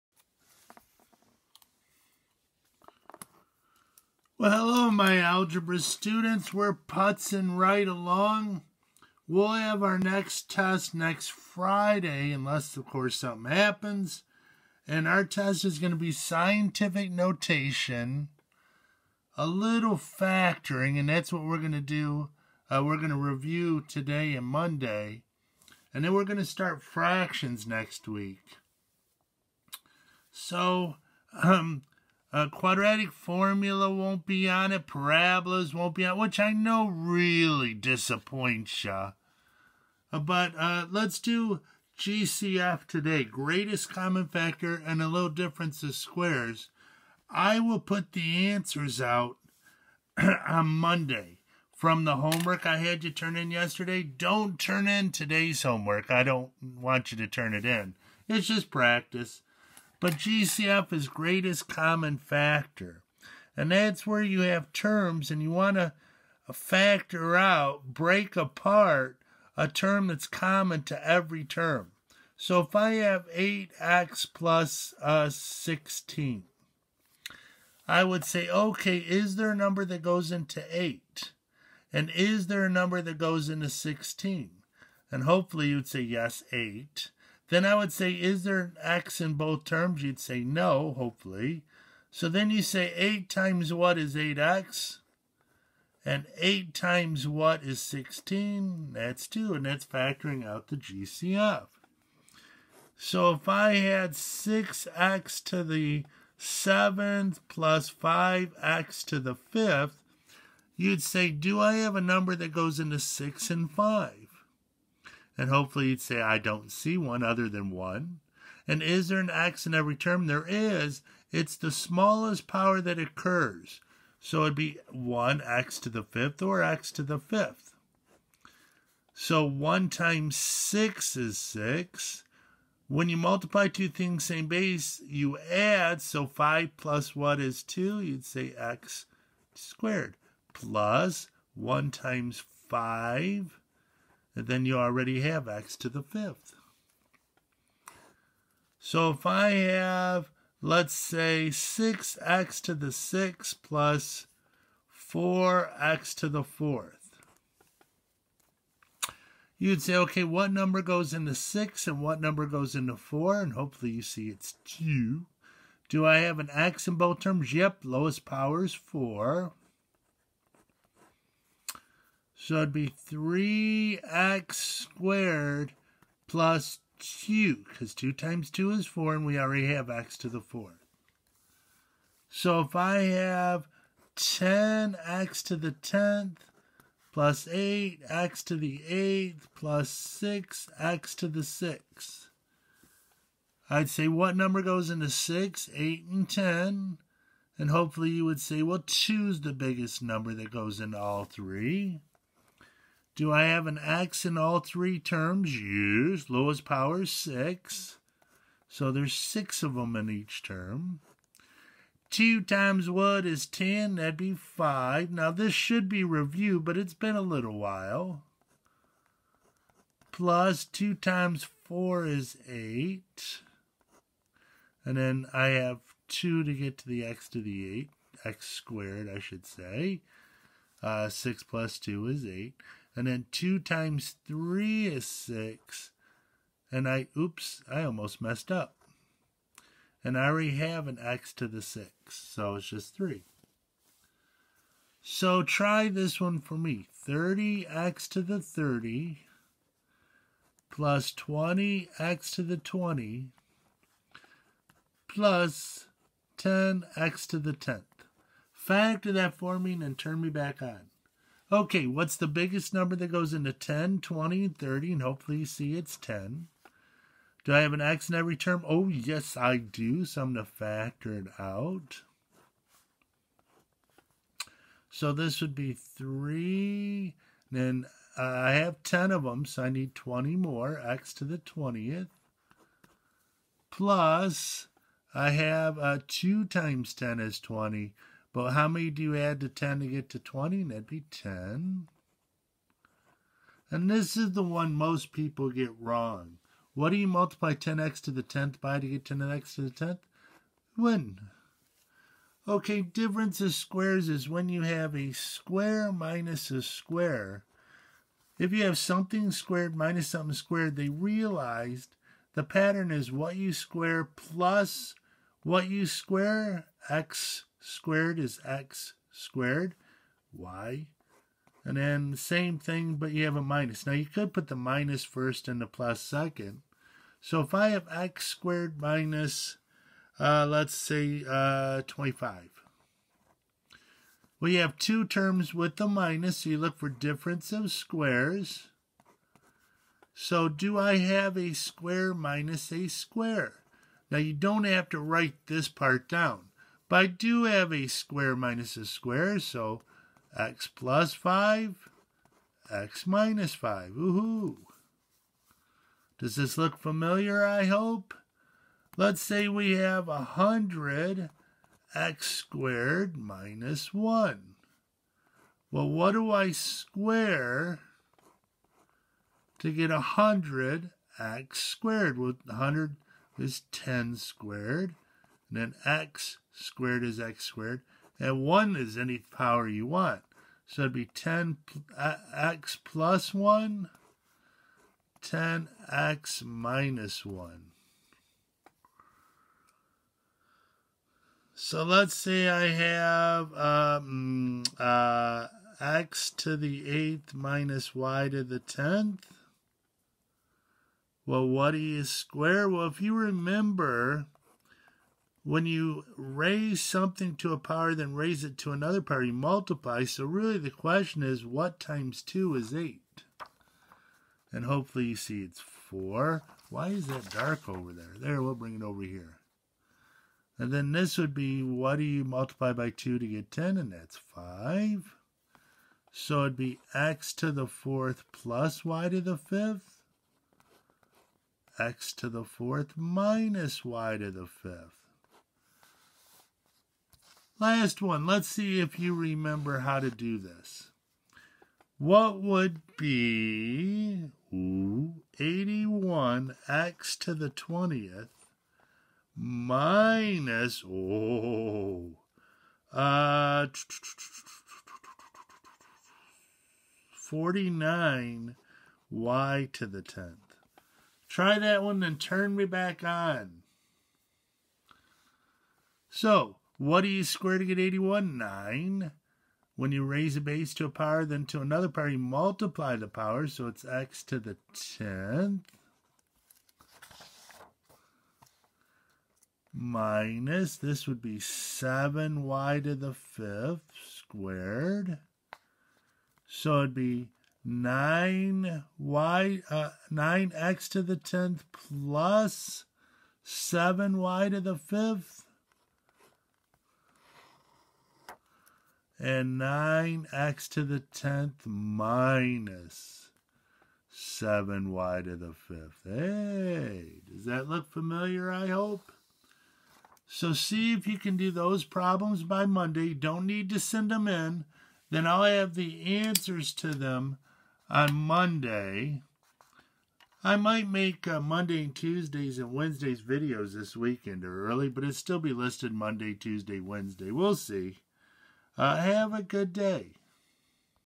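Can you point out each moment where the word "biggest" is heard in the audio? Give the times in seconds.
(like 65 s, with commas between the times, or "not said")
199 s, 262 s.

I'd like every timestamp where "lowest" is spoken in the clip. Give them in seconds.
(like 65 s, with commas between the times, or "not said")
167 s, 206 s.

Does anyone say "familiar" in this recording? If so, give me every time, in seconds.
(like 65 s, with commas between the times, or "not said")
356 s, 507 s.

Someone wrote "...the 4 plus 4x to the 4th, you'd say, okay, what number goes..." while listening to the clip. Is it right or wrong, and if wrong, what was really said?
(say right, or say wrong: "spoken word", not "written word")
wrong: "6", not "4".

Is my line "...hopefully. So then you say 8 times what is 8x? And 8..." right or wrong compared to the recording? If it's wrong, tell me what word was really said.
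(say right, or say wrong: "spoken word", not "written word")
right.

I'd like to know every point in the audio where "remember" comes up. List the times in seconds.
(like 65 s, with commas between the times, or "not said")
403 s, 439 s.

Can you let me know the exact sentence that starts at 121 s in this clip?
It's the smallest power that occurs.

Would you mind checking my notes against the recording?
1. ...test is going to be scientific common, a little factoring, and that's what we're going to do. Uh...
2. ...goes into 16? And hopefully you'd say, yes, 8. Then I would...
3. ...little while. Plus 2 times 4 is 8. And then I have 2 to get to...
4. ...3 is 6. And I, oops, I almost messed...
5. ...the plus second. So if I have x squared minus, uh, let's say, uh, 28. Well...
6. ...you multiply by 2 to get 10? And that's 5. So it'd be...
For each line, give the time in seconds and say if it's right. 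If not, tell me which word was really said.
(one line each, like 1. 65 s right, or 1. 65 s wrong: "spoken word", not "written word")
1. 15 s wrong: "notation", not "common"
2. 83 s right
3. 217 s right
4. 234 s right
5. 325 s wrong: "25", not "28"
6. 422 s right.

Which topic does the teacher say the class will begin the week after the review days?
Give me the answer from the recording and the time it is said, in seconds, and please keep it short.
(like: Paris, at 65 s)
Fractions, at 26 s.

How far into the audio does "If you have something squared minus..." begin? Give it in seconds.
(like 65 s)
308 s.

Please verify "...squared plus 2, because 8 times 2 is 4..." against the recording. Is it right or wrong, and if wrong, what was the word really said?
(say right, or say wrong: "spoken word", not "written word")
wrong: "2", not "8".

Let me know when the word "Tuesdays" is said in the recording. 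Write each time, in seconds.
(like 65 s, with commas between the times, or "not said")
521 s, 526 s.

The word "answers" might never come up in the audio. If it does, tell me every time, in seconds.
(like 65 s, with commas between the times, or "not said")
48 s, 516 s.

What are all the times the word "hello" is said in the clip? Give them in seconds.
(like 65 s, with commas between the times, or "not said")
4 s.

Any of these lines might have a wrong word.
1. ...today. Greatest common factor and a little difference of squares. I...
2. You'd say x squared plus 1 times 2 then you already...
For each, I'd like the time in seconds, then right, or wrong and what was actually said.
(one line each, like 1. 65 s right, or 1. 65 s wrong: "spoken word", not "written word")
1. 42 s right
2. 138 s wrong: "5", not "2".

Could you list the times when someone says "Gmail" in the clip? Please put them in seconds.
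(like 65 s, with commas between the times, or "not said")
not said.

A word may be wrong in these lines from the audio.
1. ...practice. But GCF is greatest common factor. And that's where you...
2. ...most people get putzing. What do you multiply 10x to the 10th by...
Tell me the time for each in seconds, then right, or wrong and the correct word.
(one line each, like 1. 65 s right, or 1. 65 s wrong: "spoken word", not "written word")
1. 58 s right
2. 294 s wrong: "wrong", not "putzing".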